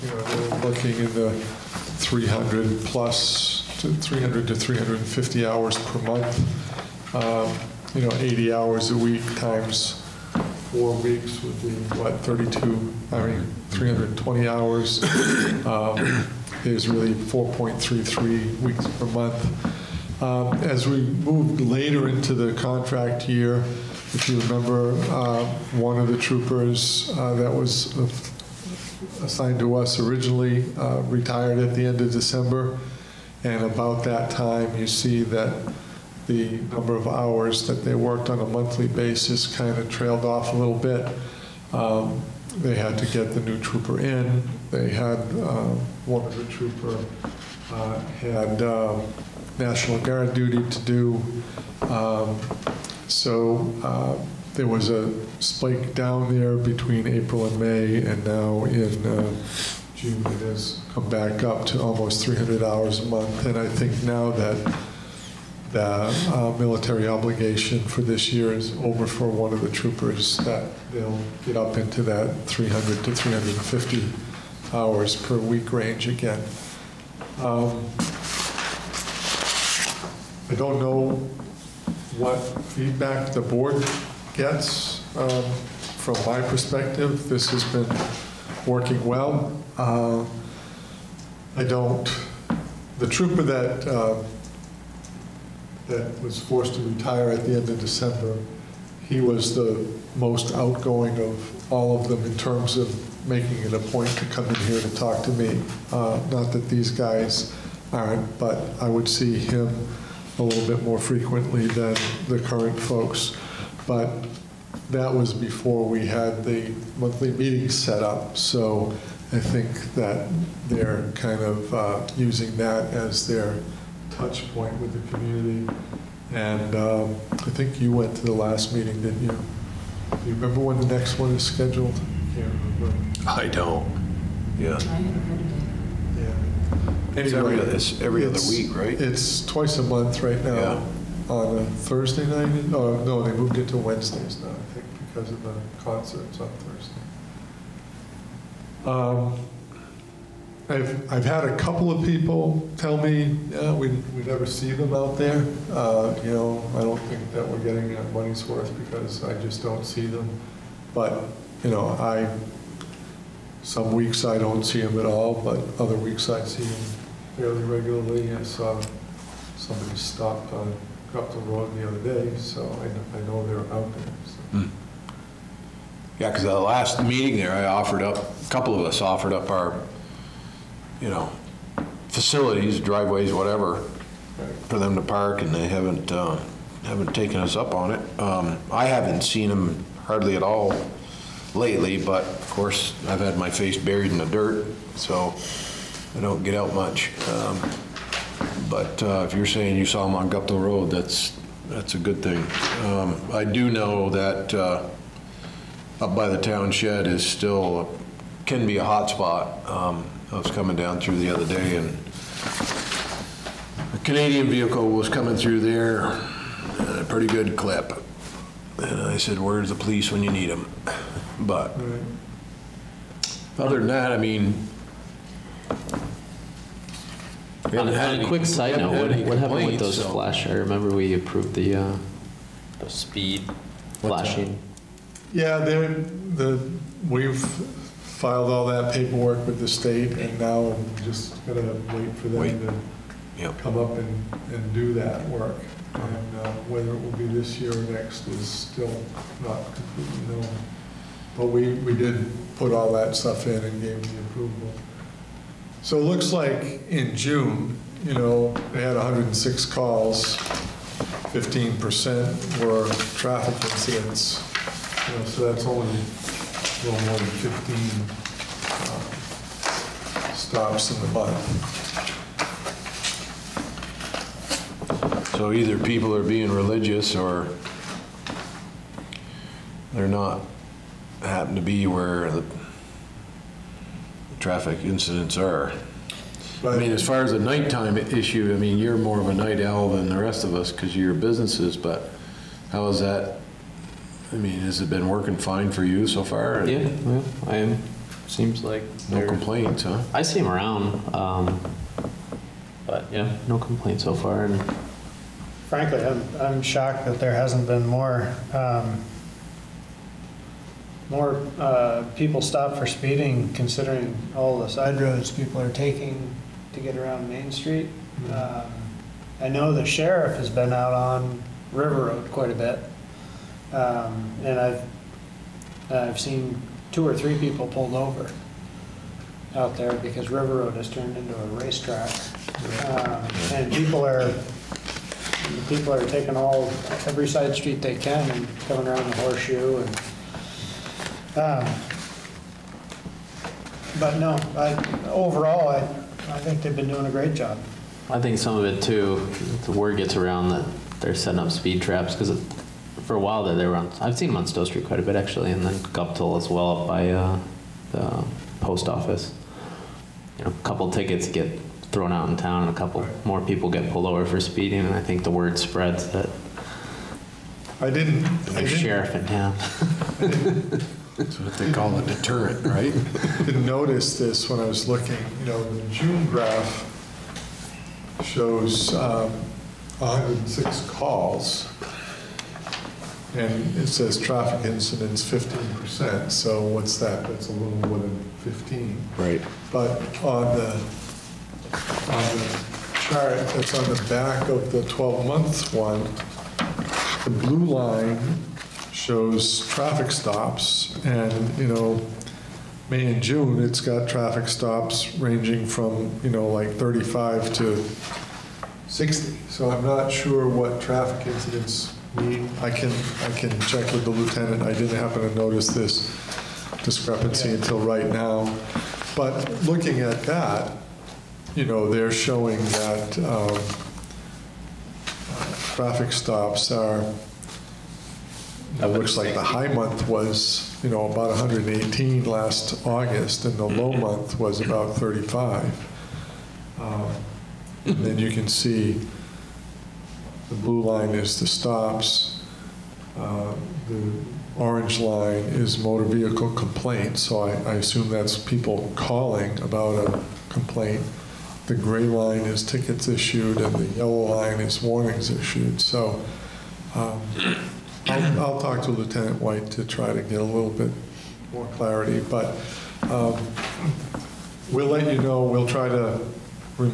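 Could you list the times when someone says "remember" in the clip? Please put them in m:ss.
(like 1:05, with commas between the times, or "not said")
0:24, 2:10, 3:50.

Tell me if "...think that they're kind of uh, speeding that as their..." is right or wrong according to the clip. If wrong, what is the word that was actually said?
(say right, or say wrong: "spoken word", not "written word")
wrong: "using", not "speeding".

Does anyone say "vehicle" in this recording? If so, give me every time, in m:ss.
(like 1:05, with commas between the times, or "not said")
3:34, 7:26.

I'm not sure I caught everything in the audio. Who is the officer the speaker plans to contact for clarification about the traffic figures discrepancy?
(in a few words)
Lieutenant White.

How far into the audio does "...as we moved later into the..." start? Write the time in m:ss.
0:20.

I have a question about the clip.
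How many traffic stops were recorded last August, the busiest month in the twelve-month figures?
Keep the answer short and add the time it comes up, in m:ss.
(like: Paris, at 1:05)
118, at 7:11.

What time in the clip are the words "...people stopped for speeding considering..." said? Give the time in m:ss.
5:12.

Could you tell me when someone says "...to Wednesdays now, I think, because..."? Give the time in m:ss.
2:23.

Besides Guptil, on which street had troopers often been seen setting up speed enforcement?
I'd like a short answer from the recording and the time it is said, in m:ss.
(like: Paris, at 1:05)
Stowe Street, at 5:54.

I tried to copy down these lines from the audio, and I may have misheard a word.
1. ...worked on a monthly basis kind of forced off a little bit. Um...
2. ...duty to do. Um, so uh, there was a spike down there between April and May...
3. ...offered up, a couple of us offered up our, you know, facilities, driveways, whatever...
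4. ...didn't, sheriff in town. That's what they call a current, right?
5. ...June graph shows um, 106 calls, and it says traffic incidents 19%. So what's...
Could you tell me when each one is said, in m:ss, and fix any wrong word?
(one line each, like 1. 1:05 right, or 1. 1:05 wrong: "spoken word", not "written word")
1. 0:37 wrong: "trailed", not "forced"
2. 0:50 right
3. 2:57 right
4. 6:08 wrong: "deterrent", not "current"
5. 6:15 wrong: "15", not "19".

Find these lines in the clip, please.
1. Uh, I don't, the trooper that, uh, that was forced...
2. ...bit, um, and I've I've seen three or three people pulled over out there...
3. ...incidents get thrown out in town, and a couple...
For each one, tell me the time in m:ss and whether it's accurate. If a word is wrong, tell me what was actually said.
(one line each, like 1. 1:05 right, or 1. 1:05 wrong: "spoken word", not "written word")
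1. 1:29 right
2. 5:22 wrong: "two", not "three"
3. 6:00 wrong: "tickets", not "incidents".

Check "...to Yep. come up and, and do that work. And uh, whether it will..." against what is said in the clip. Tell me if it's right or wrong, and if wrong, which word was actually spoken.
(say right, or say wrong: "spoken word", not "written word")
right.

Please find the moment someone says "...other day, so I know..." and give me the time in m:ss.
2:51.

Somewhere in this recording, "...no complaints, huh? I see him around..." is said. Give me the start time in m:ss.
4:59.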